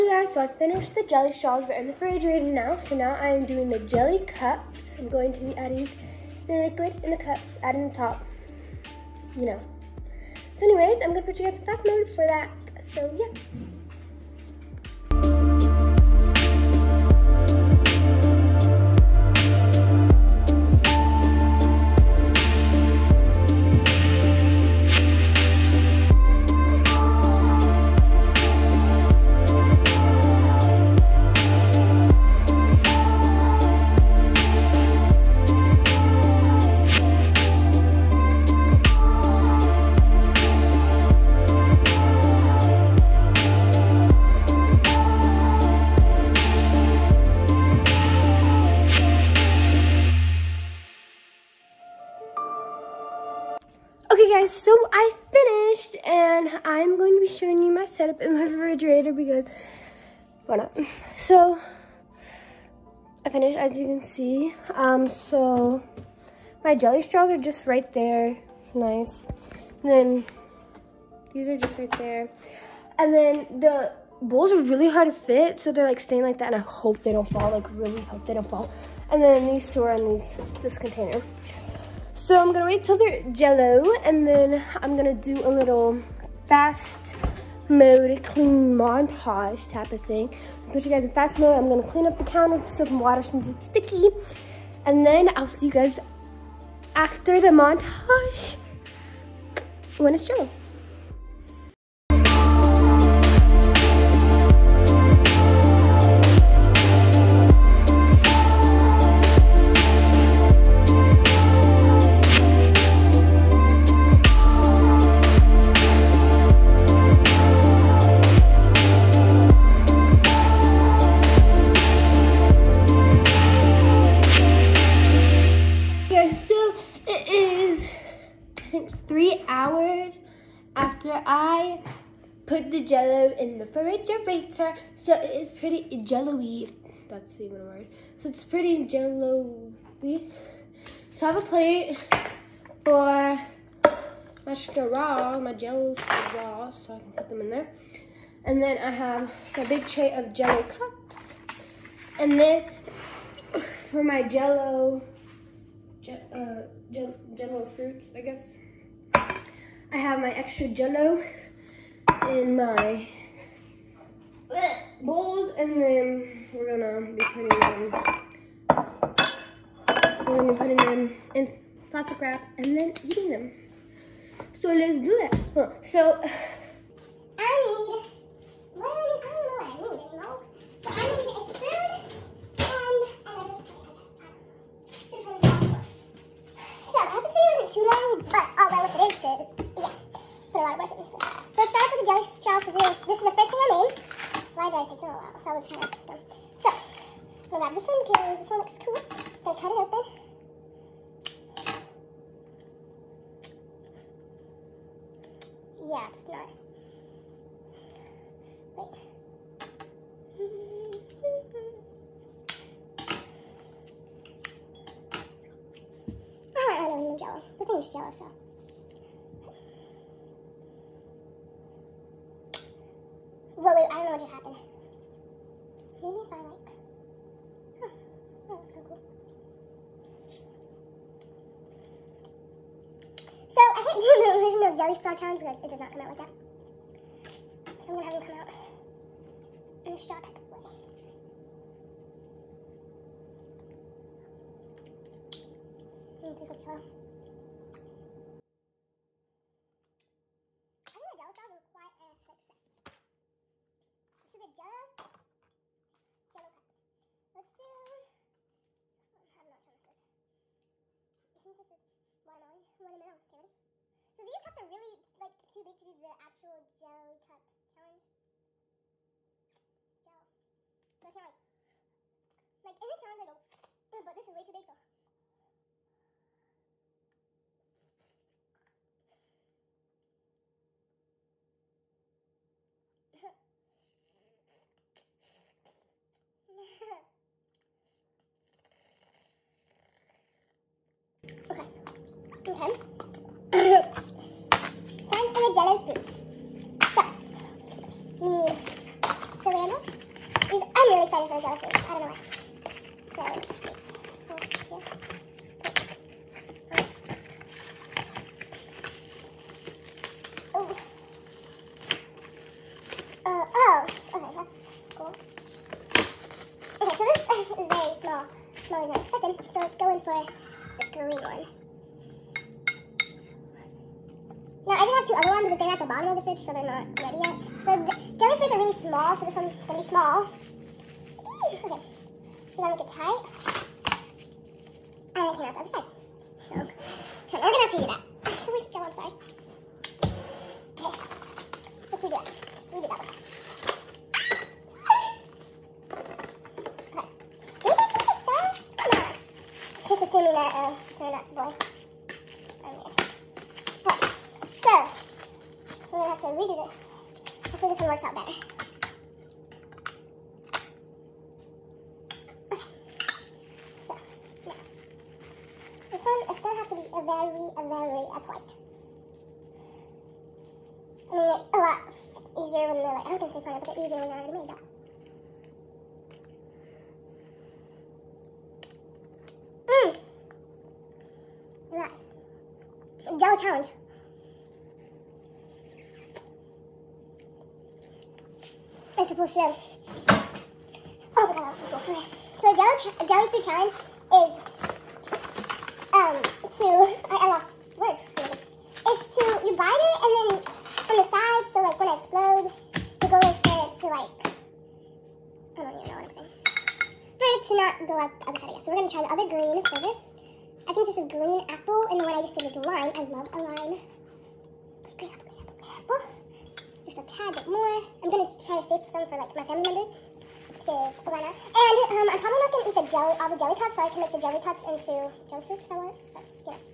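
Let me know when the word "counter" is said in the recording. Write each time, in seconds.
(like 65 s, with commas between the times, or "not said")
92 s.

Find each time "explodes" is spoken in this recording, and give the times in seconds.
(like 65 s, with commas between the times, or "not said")
401 s.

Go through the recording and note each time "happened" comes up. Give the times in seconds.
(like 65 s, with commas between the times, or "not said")
224 s.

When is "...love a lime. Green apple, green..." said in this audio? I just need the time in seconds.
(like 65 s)
413 s.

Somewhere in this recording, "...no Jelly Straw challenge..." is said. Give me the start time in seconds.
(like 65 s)
234 s.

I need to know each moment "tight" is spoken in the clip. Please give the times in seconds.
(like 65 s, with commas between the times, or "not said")
332 s.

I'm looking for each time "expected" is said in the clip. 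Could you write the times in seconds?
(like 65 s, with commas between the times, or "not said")
319 s.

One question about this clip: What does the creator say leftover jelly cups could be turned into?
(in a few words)
Jelly fruit salad.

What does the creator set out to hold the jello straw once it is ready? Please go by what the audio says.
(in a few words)
A plate.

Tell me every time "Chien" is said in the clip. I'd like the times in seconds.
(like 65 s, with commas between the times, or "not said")
not said.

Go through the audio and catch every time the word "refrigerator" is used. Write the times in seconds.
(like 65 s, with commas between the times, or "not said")
1 s, 58 s, 133 s.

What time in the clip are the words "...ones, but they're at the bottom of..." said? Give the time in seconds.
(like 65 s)
325 s.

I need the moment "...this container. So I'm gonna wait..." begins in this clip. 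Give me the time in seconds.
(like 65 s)
80 s.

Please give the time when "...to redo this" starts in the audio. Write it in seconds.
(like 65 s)
356 s.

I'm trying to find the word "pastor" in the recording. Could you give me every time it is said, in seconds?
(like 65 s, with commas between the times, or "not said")
not said.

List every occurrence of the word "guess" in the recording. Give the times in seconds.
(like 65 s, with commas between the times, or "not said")
158 s.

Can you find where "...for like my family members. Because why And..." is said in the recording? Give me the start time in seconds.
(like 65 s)
419 s.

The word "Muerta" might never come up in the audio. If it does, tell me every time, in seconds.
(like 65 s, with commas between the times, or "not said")
not said.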